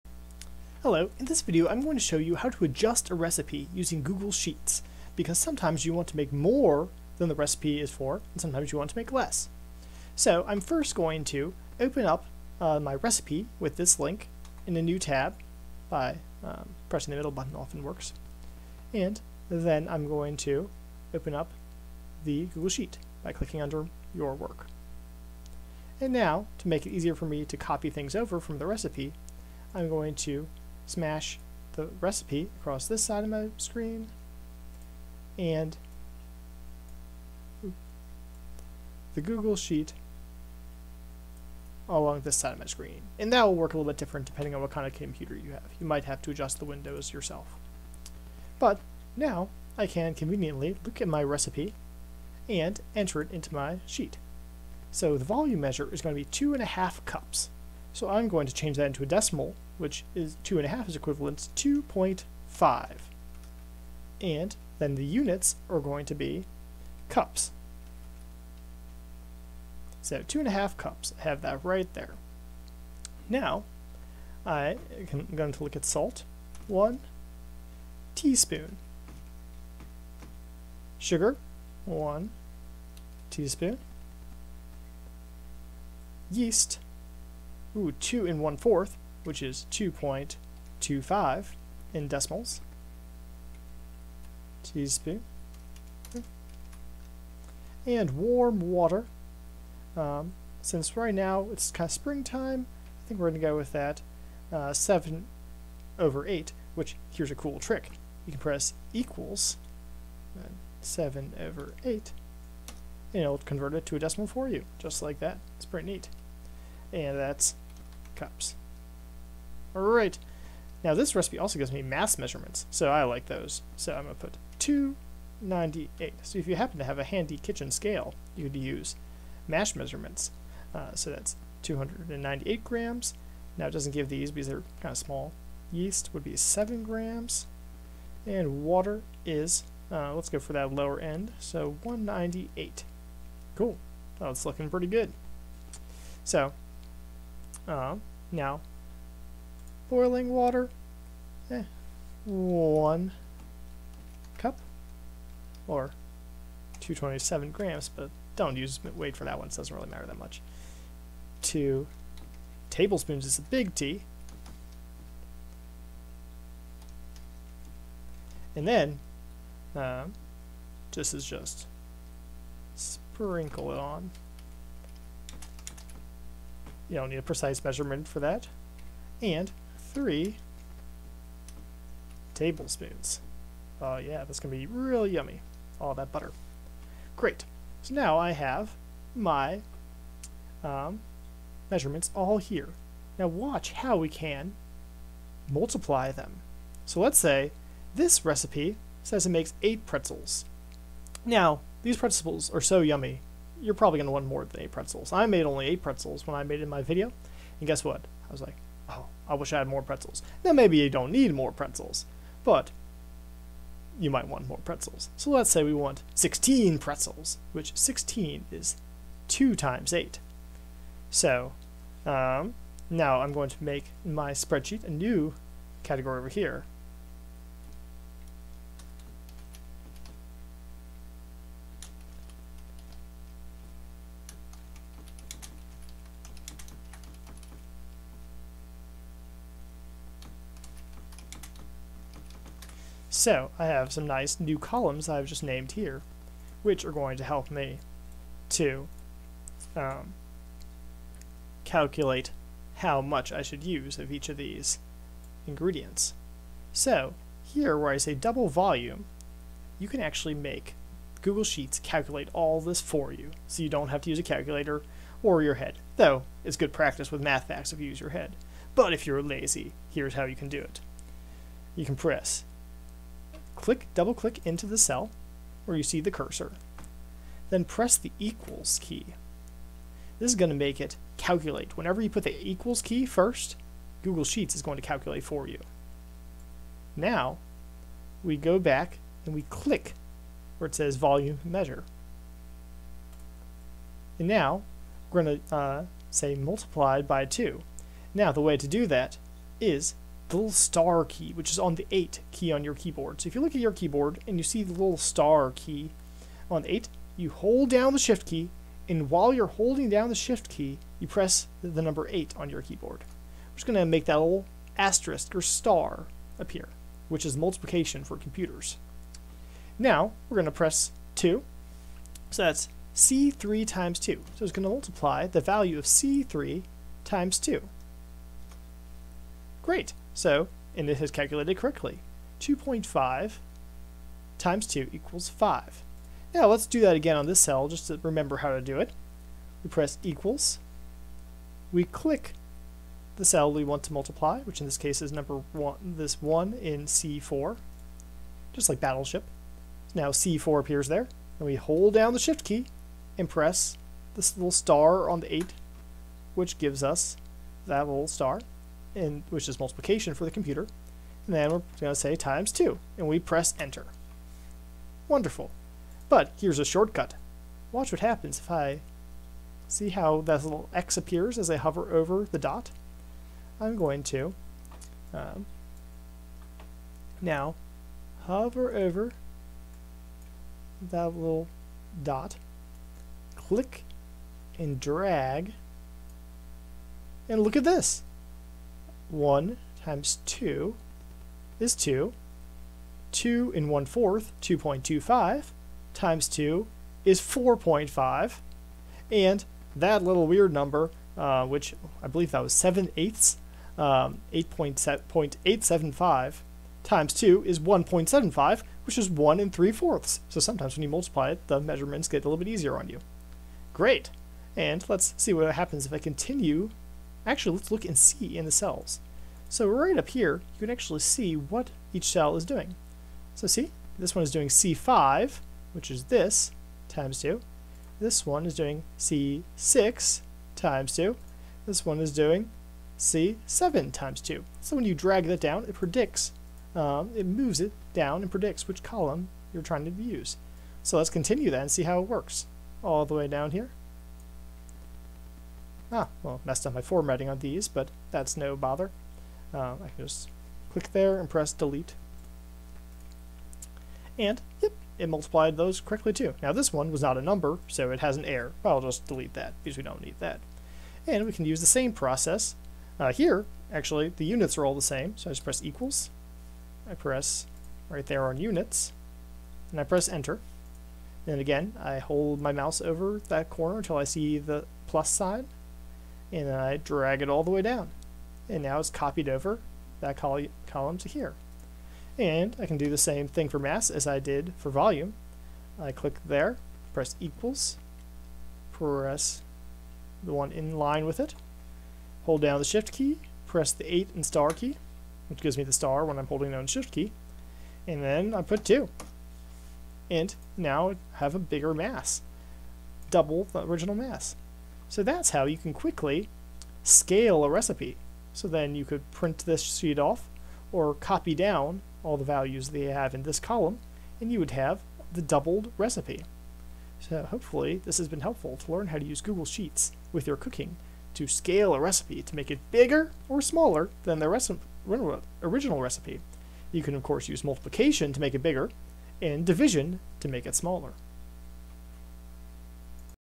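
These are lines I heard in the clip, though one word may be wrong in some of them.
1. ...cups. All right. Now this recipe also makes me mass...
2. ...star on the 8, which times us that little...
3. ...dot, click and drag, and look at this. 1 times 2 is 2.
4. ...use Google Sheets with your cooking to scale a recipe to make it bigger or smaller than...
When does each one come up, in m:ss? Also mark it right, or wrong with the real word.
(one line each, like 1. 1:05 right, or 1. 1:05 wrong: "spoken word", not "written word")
1. 1:58 wrong: "gives", not "makes"
2. 5:54 wrong: "gives", not "times"
3. 6:22 right
4. 8:39 right.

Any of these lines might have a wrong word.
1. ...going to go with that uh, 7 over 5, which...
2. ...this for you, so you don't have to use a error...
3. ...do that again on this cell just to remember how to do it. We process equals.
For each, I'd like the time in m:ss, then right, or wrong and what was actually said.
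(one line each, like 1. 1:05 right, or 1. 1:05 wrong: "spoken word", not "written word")
1. 1:43 wrong: "8", not "5"
2. 4:22 wrong: "calculator", not "error"
3. 5:36 wrong: "press", not "process".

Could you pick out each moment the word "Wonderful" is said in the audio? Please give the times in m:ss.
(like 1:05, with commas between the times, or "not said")
6:05.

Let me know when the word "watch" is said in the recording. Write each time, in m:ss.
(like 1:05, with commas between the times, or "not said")
3:13, 6:07.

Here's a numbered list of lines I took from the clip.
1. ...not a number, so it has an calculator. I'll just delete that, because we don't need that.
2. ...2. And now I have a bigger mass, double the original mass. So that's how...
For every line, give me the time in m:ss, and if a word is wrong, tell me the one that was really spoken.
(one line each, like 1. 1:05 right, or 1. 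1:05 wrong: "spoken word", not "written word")
1. 7:37 wrong: "error", not "calculator"
2. 8:18 right.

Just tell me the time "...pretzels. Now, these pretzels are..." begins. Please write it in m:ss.
3:19.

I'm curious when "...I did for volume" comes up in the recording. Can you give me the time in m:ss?
8:04.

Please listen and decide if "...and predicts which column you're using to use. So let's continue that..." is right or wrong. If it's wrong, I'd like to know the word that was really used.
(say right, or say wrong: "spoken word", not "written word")
wrong: "trying", not "using".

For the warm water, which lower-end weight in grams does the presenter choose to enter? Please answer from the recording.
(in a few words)
198.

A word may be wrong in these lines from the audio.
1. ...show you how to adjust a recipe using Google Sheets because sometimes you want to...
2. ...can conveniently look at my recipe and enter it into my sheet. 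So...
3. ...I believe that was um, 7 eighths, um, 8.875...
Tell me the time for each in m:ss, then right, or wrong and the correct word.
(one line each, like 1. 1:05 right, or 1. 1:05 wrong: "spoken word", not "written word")
1. 0:02 right
2. 0:49 right
3. 6:42 right.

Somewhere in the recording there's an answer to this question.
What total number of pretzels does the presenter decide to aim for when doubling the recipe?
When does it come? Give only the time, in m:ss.
3:36.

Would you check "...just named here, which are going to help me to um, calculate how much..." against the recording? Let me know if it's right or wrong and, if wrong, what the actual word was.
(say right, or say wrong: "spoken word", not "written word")
right.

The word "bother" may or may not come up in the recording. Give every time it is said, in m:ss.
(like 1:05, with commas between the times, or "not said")
7:28.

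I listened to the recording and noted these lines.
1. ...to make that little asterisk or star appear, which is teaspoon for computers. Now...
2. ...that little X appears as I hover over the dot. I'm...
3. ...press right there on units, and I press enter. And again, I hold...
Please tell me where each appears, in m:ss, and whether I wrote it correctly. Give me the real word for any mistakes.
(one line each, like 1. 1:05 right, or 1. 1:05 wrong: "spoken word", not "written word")
1. 5:13 wrong: "multiplication", not "teaspoon"
2. 6:10 right
3. 7:46 right.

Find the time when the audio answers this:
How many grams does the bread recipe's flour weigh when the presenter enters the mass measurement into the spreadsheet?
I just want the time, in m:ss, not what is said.
2:11.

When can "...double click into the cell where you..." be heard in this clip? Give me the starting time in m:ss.
4:33.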